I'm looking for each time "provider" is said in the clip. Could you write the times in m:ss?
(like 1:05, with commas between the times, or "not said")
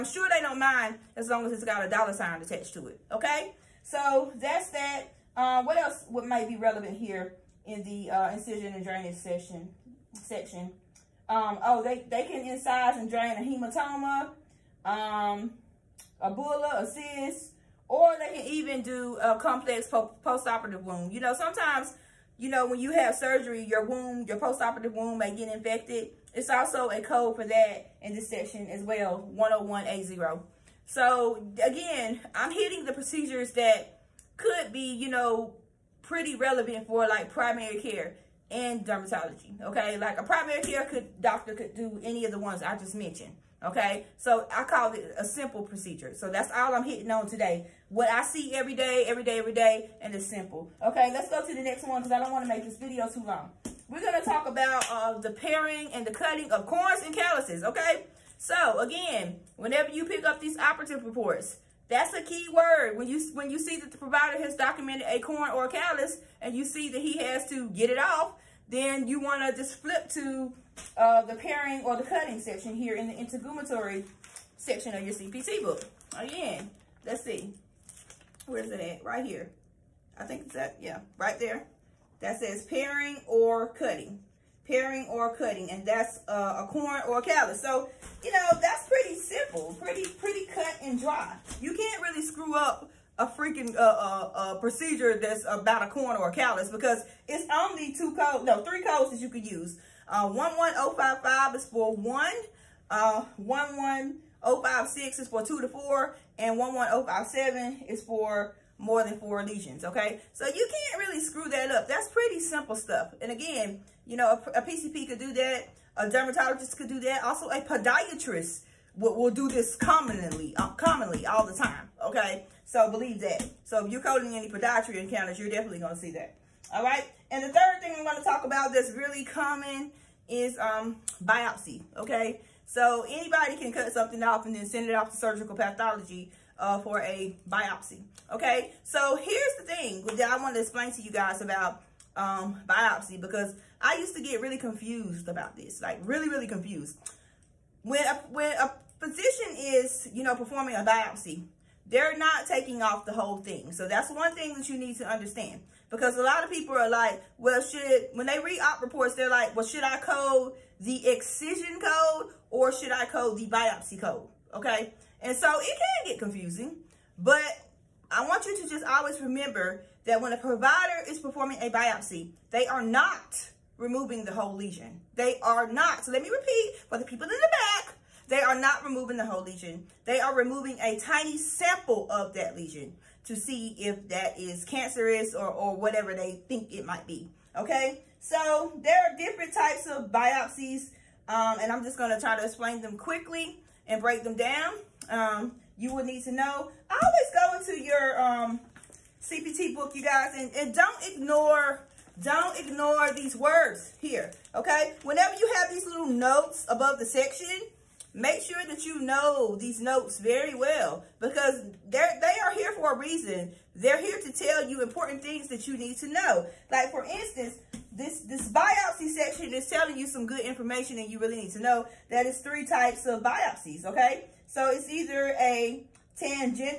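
1:03, 2:50.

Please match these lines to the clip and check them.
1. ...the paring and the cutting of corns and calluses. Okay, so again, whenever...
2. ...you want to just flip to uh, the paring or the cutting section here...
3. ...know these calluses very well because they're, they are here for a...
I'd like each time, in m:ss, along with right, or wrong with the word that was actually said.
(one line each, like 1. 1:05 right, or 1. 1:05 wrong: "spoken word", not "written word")
1. 0:55 right
2. 1:09 right
3. 3:29 wrong: "notes", not "calluses".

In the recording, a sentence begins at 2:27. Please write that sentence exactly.
When a, when a physician is, you know, performing a biopsy, they're not taking off the whole thing.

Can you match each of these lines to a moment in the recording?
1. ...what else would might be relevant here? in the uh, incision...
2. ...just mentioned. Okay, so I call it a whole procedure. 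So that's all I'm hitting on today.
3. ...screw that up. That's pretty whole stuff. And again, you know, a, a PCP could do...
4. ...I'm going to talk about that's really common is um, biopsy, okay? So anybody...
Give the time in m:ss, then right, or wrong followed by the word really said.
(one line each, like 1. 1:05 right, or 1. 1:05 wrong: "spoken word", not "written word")
1. 0:05 right
2. 0:42 wrong: "simple", not "whole"
3. 1:51 wrong: "simple", not "whole"
4. 2:07 right.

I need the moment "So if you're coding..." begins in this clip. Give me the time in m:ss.
2:03.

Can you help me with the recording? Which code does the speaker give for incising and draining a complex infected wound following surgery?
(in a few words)
101A0.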